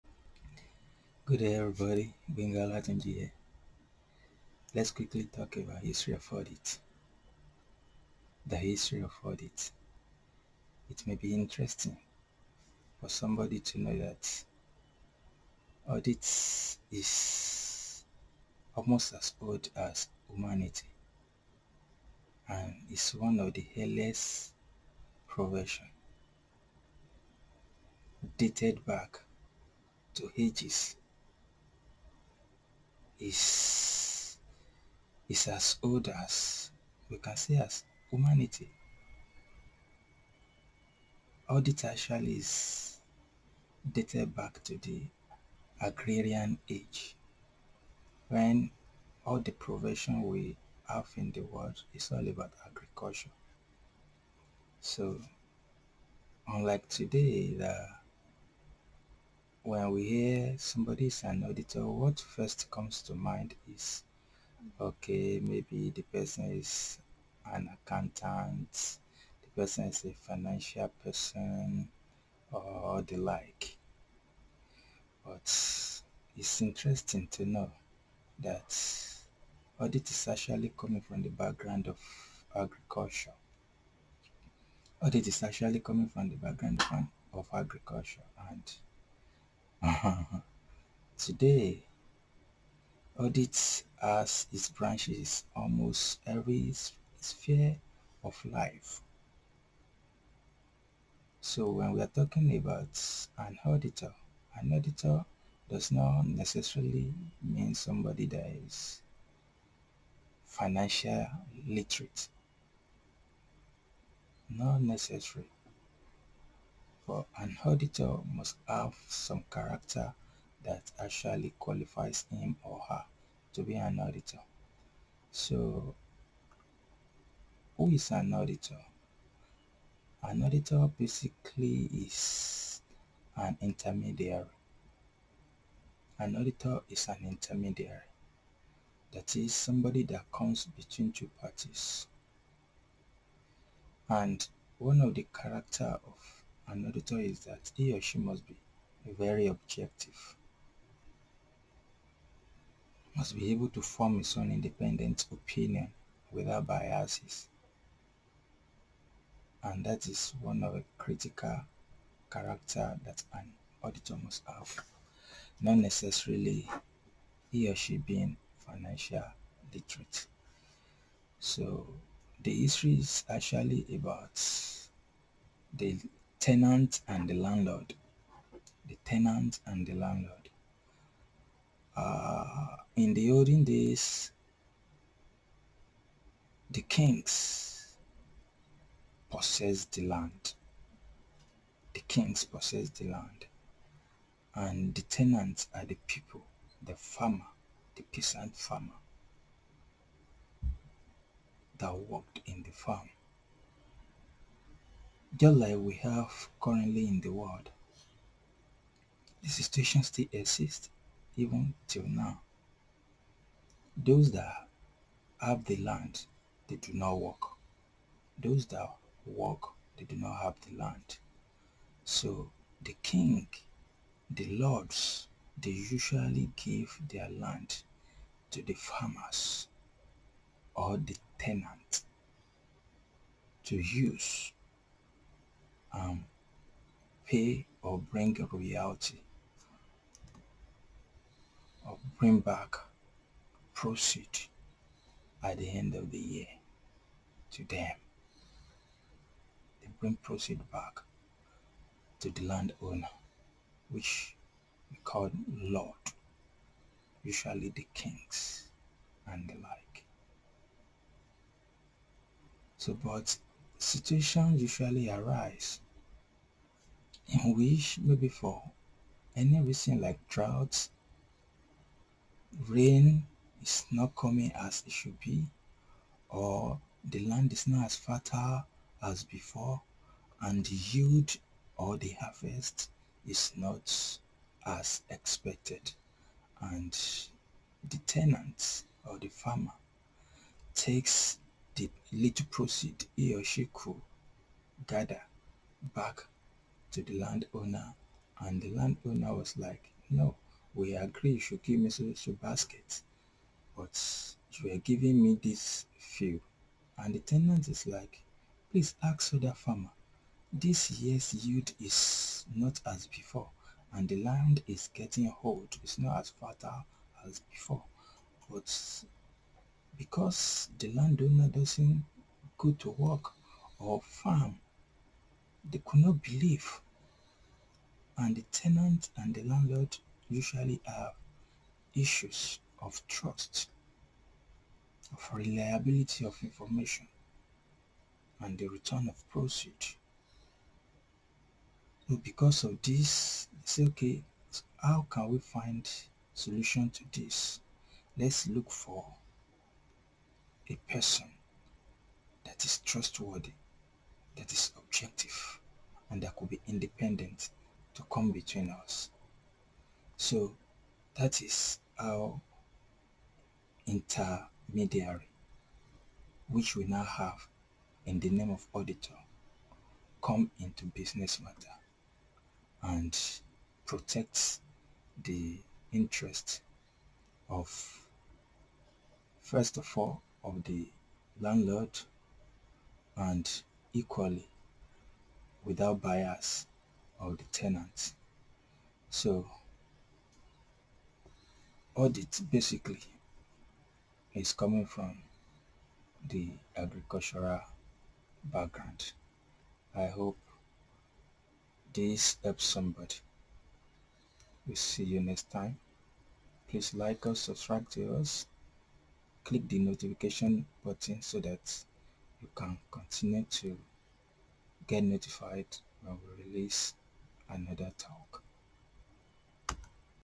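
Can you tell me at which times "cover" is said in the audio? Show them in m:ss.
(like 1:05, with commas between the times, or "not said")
not said.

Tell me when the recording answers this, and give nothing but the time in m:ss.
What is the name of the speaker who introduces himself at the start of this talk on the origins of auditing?
0:02.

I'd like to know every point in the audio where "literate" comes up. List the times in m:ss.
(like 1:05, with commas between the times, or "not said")
1:51, 2:49.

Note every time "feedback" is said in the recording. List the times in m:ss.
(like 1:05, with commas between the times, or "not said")
not said.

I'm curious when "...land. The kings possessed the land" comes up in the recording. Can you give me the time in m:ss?
3:10.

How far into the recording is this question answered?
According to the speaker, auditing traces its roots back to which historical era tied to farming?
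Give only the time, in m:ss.
0:45.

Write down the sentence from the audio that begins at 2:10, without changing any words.
An auditor basically is an intermediary.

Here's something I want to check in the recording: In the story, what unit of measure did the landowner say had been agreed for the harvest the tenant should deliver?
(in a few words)
baskets.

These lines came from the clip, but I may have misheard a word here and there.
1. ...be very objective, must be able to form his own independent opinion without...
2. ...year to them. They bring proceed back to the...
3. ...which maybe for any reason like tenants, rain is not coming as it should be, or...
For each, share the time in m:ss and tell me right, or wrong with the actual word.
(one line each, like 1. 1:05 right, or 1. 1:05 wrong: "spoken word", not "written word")
1. 2:28 right
2. 4:06 right
3. 4:27 wrong: "droughts", not "tenants".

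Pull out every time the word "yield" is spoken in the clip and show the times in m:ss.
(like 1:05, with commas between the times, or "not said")
4:40, 5:11.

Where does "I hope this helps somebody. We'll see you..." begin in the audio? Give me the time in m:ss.
6:39.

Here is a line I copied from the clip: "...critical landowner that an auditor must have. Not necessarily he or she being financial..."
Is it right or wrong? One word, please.
wrong.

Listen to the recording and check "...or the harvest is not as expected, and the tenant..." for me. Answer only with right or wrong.
right.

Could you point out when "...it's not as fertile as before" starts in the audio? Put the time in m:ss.
5:15.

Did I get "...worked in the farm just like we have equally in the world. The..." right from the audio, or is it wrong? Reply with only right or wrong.
wrong.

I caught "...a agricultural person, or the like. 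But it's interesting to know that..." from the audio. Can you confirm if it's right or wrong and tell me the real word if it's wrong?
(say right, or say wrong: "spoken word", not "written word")
wrong: "financial", not "agricultural".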